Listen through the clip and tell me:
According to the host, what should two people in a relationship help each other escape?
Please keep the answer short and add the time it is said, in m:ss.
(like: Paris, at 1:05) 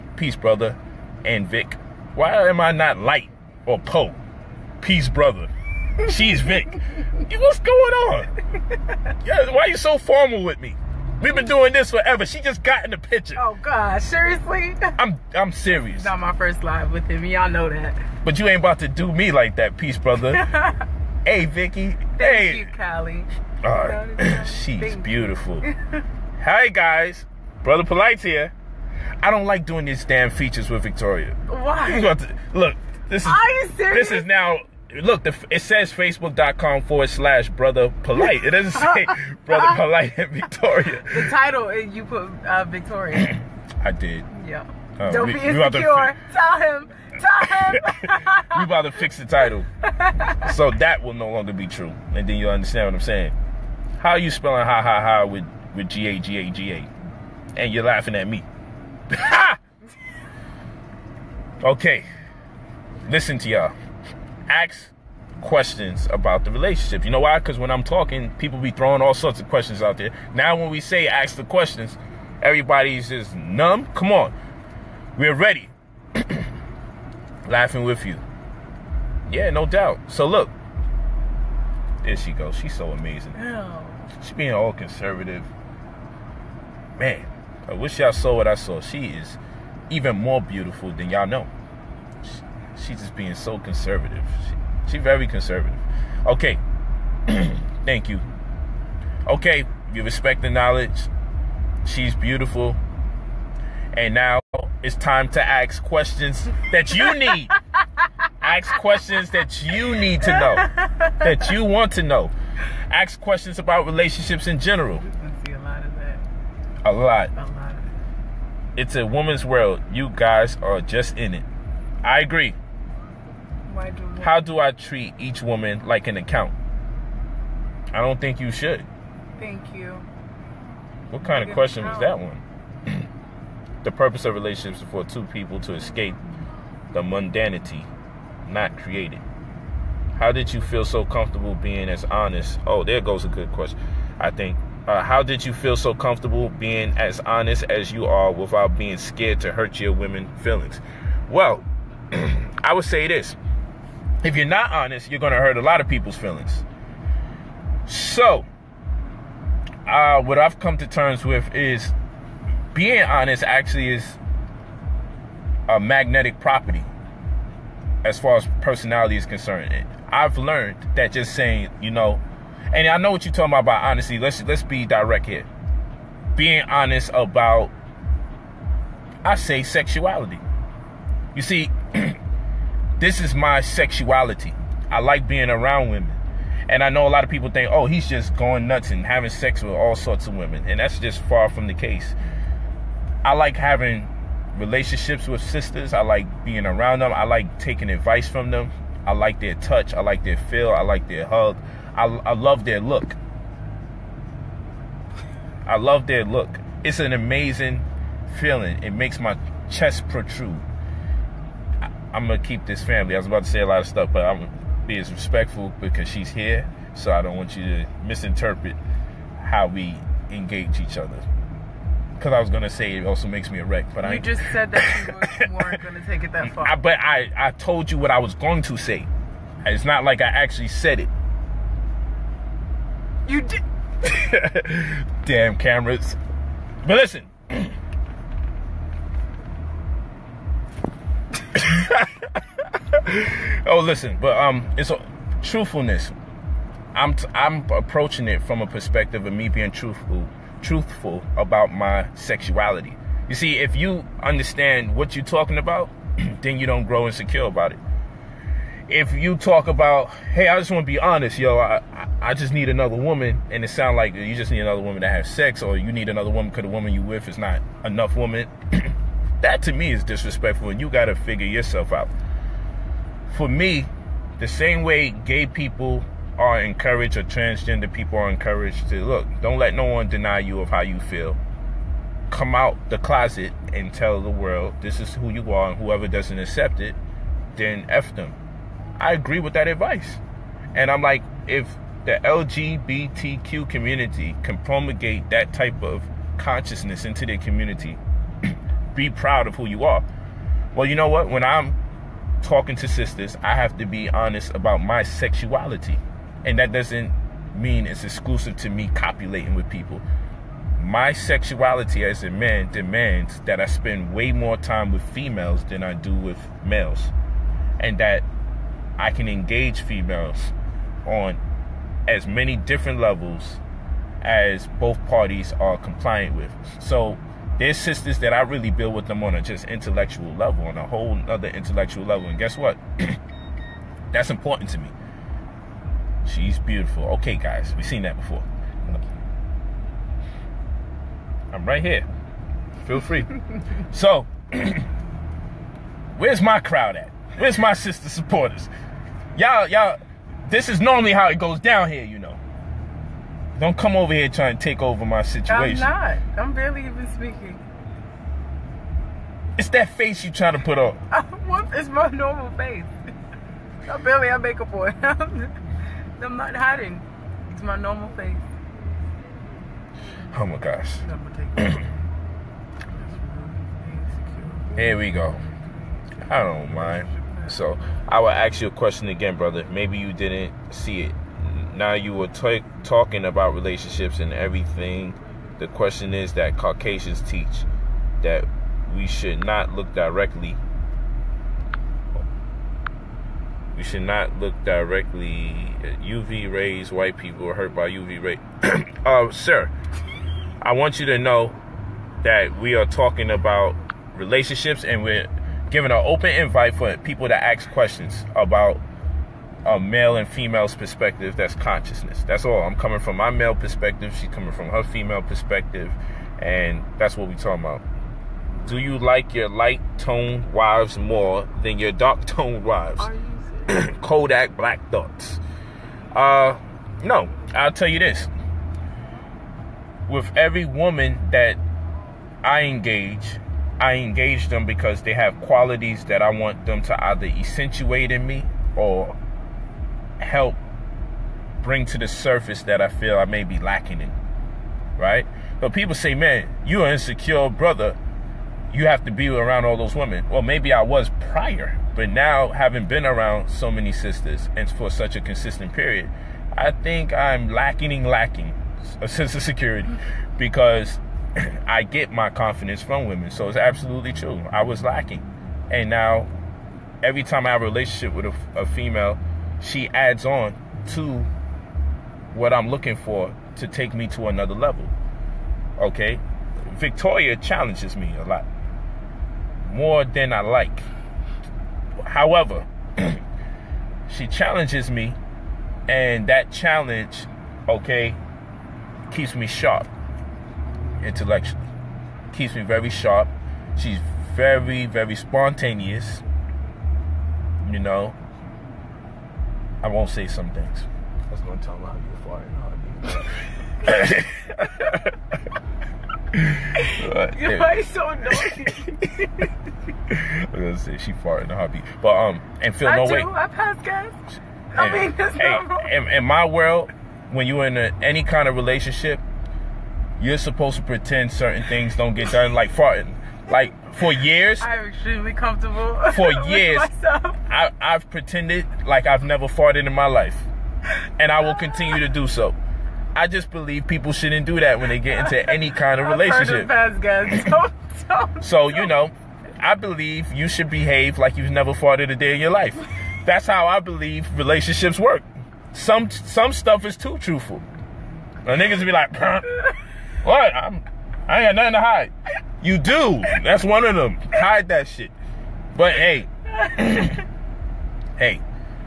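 mundanity, at 2:15.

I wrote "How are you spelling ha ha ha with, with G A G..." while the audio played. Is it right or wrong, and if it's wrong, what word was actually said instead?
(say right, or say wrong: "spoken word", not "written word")
right.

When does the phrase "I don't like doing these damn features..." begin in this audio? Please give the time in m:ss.
0:29.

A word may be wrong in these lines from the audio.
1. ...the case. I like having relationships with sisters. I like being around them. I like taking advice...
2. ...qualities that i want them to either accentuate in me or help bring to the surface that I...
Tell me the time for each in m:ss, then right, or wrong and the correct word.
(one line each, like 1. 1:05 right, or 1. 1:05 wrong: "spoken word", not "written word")
1. 3:11 right
2. 7:15 right.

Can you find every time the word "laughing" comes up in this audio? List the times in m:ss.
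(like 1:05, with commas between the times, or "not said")
0:57, 1:17.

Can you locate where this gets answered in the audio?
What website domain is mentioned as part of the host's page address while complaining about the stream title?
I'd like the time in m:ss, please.
0:35.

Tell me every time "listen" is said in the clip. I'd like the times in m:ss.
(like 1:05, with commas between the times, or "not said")
1:03, 3:56, 4:03.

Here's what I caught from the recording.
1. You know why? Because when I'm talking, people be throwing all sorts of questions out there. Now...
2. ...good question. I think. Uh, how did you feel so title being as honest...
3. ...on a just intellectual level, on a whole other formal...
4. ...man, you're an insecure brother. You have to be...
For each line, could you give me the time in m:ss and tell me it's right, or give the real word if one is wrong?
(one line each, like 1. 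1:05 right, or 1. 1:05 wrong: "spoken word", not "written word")
1. 1:07 right
2. 2:23 wrong: "comfortable", not "title"
3. 5:29 wrong: "intellectual", not "formal"
4. 7:26 right.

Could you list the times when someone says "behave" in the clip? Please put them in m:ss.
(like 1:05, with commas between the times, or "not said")
9:00.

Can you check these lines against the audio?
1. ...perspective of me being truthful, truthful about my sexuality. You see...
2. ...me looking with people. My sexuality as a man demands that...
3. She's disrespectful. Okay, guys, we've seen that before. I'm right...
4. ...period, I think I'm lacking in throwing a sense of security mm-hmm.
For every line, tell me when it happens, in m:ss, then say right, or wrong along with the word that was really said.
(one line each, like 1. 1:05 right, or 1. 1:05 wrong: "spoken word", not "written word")
1. 4:08 right
2. 5:08 wrong: "copulating", not "looking"
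3. 5:36 wrong: "beautiful", not "disrespectful"
4. 7:35 wrong: "lacking", not "throwing".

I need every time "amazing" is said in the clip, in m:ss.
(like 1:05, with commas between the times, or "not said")
1:22, 3:27.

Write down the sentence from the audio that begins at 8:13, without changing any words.
She's very, very spontaneous, you know, I won't say some things.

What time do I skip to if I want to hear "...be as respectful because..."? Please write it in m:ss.
3:34.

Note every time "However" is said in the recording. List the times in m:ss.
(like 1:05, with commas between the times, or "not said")
8:02.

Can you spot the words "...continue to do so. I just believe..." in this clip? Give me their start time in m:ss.
8:51.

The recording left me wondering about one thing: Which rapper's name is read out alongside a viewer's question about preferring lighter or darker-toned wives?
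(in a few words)
Kodak Black.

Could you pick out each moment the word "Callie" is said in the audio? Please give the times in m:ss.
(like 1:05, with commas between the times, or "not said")
0:22.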